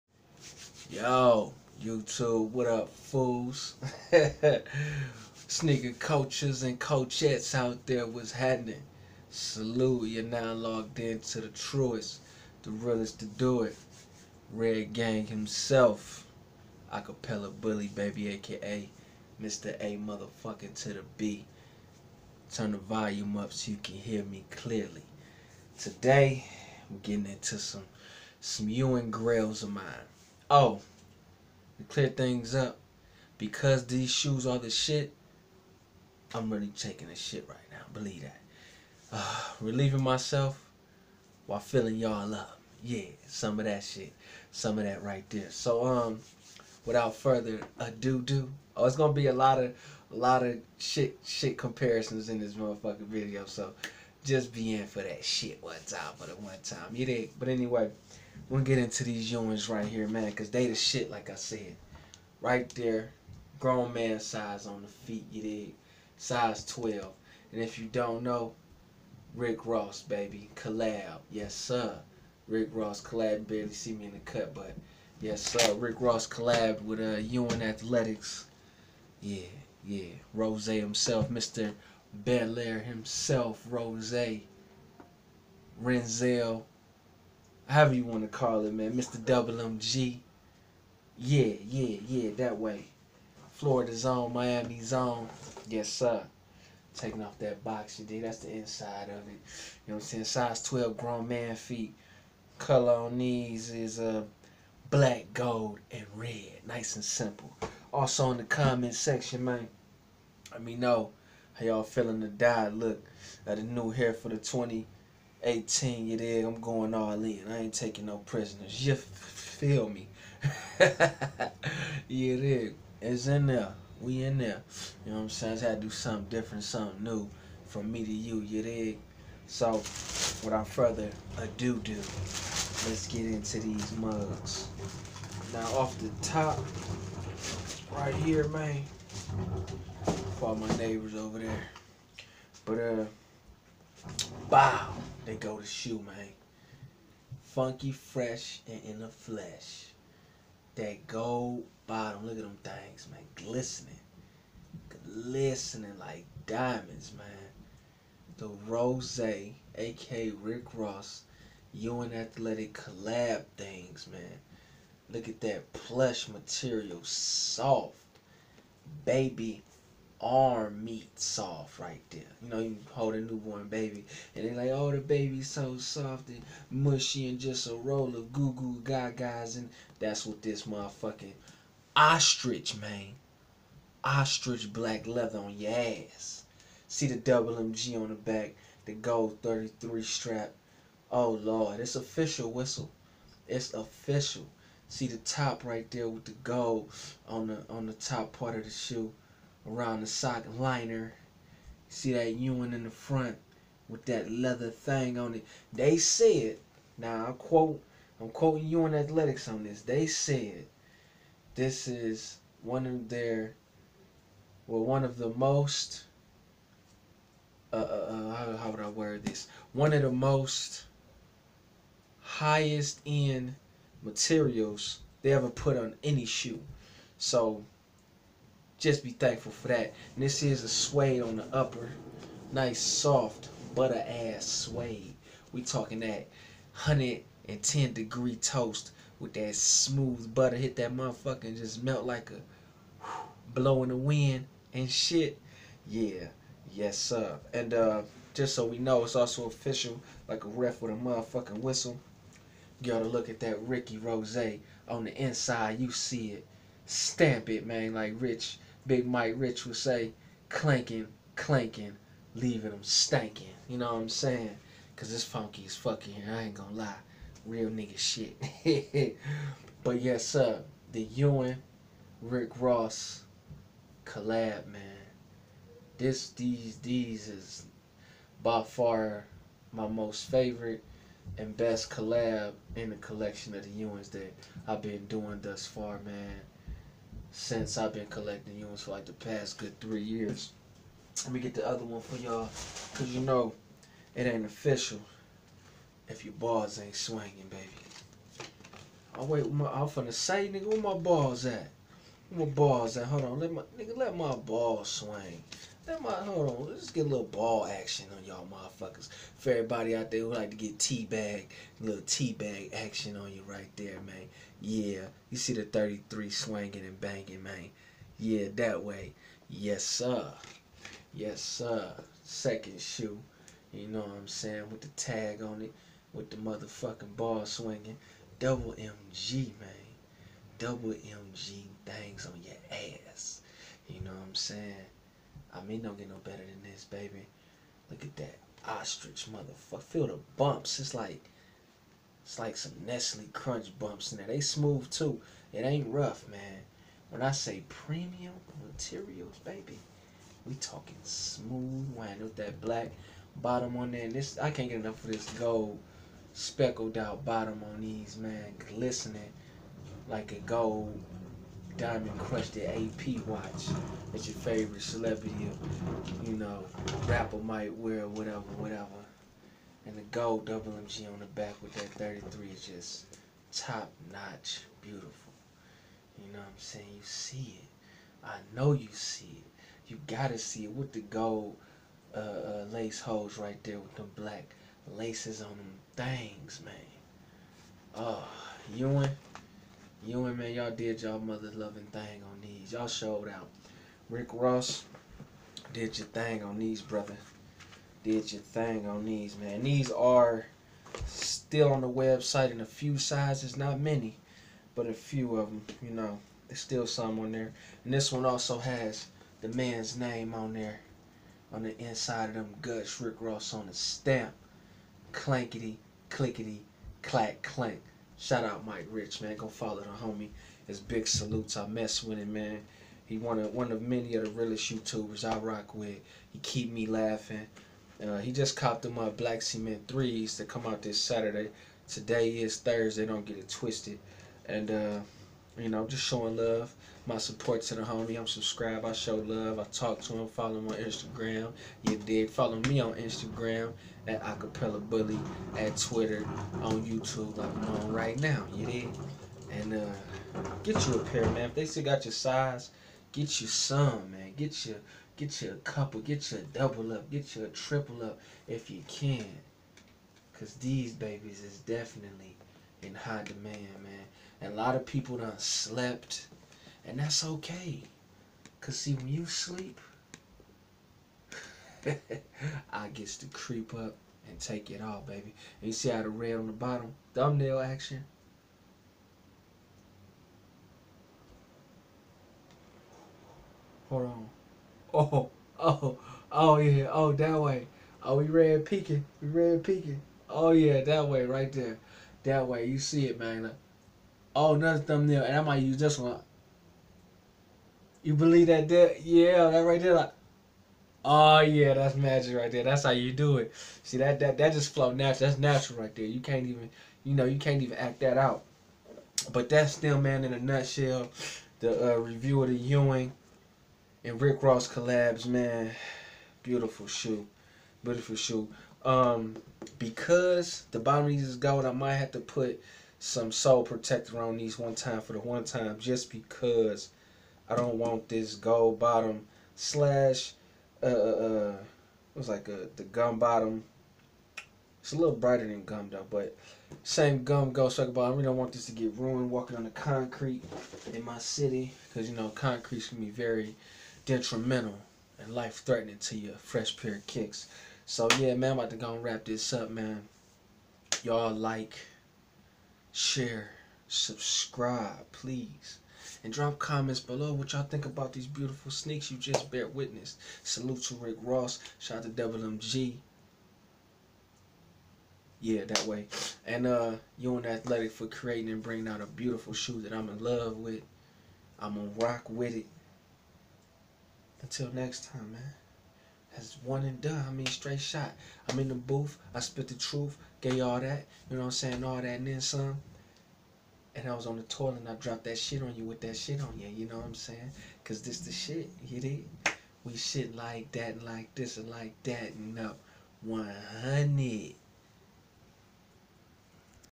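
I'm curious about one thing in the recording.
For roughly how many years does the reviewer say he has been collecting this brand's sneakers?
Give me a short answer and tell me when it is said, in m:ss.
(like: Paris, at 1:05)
3, at 4:49.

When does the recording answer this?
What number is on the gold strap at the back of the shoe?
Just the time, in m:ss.
3:08.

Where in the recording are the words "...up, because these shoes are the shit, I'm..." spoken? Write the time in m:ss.
0:32.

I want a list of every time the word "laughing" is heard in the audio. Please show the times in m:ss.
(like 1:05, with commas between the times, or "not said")
7:06.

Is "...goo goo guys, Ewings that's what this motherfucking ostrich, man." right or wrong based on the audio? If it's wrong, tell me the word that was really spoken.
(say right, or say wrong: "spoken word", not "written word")
wrong: "And", not "Ewings".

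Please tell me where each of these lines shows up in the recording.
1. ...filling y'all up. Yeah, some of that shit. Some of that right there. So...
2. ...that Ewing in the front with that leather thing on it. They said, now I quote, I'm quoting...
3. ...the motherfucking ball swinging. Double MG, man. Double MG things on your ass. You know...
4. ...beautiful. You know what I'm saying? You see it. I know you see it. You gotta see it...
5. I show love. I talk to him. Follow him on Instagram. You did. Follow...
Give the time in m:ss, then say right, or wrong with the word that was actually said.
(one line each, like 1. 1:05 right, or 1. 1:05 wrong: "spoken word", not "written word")
1. 0:41 right
2. 3:22 right
3. 5:26 right
4. 6:14 right
5. 7:18 right.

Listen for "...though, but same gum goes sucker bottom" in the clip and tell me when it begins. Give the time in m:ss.
8:55.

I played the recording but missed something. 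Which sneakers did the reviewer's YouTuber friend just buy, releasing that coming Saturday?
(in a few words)
Black Cement threes.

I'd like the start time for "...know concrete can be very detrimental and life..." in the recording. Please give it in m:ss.
9:02.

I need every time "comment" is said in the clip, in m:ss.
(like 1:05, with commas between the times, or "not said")
1:48, 9:16.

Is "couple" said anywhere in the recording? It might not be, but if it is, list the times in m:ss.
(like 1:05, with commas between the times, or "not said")
7:35.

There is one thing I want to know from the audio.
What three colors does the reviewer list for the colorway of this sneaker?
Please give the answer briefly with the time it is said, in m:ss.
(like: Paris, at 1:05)
black, gold, and red, at 1:44.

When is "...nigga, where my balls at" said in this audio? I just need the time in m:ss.
5:00.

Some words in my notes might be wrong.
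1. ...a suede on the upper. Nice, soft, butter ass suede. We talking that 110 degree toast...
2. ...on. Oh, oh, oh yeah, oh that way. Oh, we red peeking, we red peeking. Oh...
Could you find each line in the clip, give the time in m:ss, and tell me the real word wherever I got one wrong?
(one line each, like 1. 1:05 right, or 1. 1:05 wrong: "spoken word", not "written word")
1. 3:50 right
2. 8:04 right.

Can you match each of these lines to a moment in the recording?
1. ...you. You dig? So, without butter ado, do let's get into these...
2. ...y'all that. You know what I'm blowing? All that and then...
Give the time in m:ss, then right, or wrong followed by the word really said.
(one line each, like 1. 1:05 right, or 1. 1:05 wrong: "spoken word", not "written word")
1. 2:08 wrong: "further", not "butter"
2. 9:40 wrong: "saying", not "blowing".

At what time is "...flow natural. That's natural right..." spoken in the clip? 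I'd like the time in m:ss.
8:24.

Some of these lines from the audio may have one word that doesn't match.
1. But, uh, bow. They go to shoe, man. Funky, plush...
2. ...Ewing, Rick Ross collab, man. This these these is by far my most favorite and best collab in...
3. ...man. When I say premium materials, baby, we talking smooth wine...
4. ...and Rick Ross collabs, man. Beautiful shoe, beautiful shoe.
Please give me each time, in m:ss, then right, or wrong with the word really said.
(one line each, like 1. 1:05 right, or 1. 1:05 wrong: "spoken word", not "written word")
1. 2:22 wrong: "fresh", not "plush"
2. 4:31 right
3. 5:46 right
4. 8:34 right.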